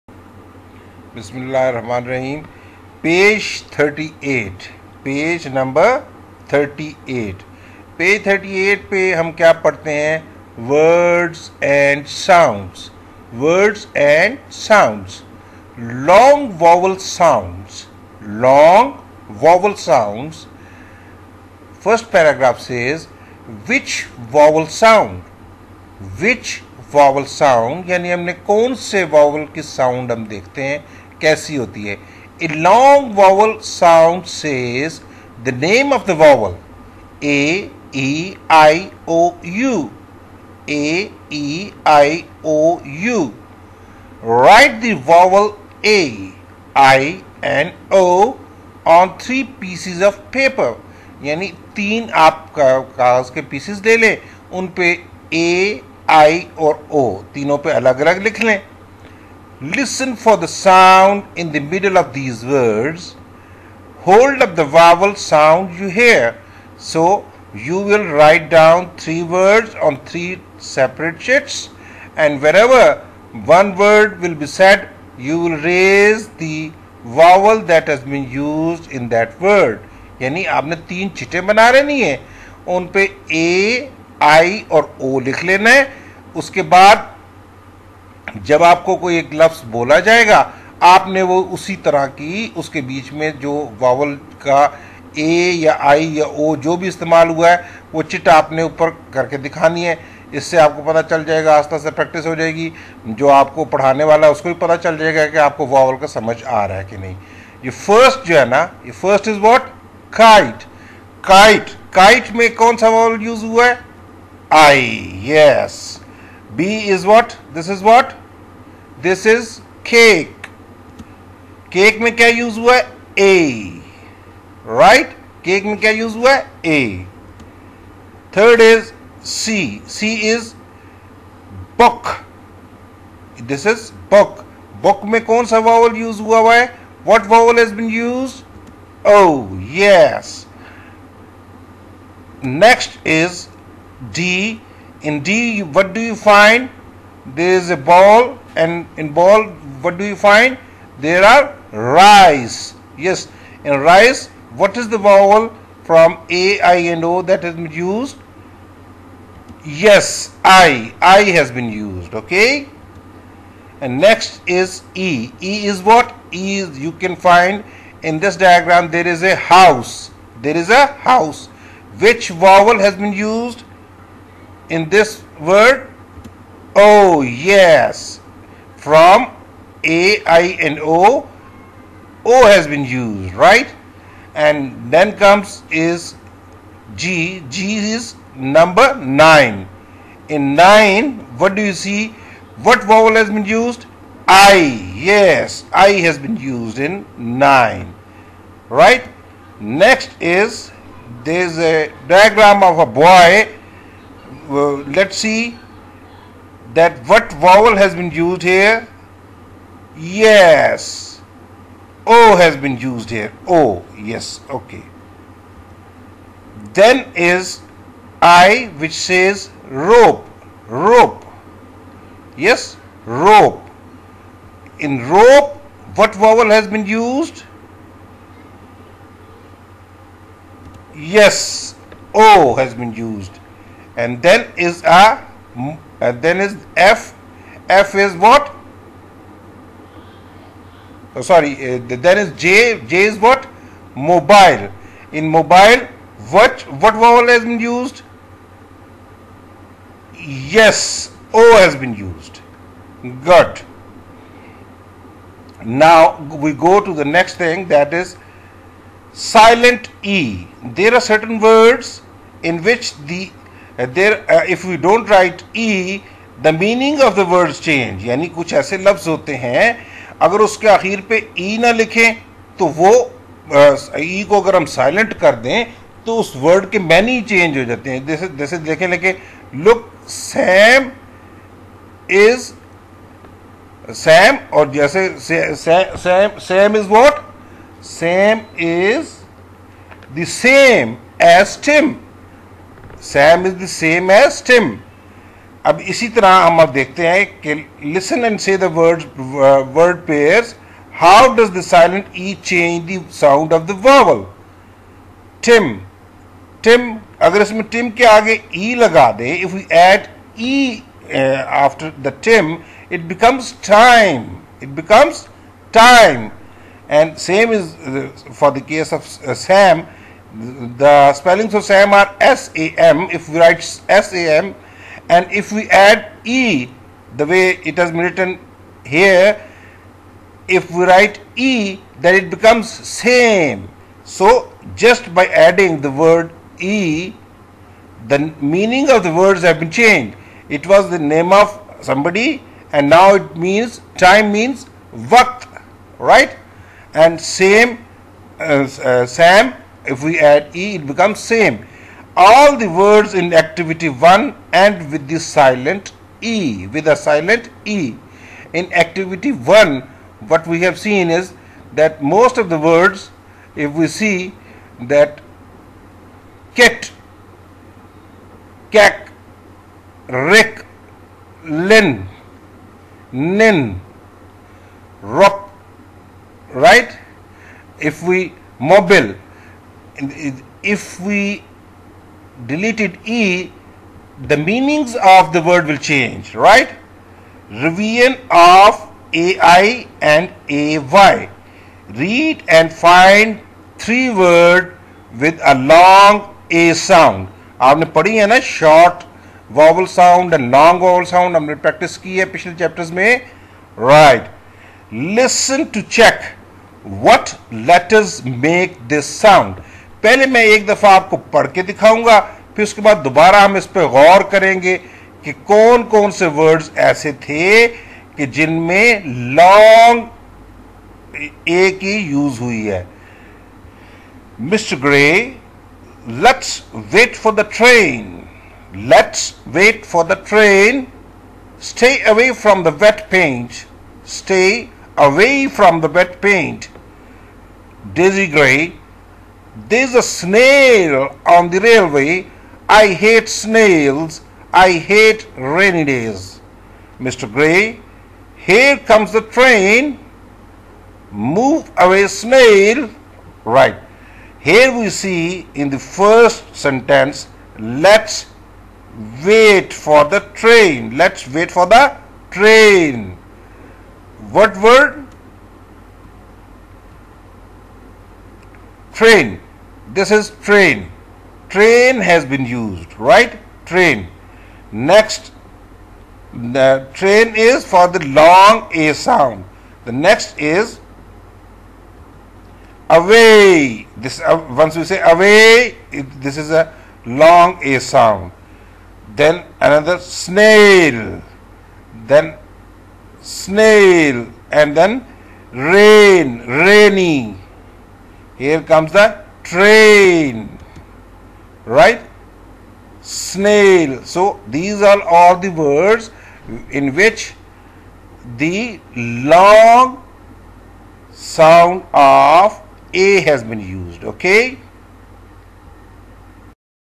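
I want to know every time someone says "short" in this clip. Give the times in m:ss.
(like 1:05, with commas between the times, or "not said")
6:38.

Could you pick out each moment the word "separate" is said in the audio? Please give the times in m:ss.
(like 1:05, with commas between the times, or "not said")
1:10.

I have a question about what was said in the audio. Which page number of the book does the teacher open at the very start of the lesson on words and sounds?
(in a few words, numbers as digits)
38.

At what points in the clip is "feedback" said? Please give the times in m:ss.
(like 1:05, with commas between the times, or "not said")
not said.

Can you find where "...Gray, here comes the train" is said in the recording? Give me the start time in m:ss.
7:27.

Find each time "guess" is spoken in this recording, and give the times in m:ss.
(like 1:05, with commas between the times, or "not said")
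not said.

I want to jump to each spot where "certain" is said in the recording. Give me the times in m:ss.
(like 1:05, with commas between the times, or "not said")
4:21.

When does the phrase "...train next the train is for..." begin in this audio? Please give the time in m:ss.
7:53.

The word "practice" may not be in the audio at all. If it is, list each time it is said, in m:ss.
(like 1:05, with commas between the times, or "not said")
6:41.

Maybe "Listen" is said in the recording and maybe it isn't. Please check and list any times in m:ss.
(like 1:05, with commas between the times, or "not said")
0:59, 6:44.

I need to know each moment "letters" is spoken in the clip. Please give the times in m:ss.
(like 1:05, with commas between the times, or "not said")
6:47.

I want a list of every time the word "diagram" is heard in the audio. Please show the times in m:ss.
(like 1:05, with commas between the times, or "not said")
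2:48, 3:22.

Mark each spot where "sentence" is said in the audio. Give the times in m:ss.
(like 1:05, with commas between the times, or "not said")
7:36.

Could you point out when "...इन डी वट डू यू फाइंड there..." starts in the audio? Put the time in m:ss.
2:25.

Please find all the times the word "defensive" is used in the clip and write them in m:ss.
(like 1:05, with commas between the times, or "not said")
not said.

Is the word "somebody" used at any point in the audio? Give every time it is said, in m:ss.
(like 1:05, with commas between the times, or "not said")
5:41.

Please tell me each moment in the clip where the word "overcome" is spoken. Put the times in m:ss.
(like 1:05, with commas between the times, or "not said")
not said.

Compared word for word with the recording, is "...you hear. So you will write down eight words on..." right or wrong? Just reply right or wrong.
wrong.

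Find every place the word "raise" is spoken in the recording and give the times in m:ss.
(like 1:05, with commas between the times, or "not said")
1:15.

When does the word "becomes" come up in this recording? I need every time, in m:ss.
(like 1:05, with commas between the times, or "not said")
5:32, 5:50.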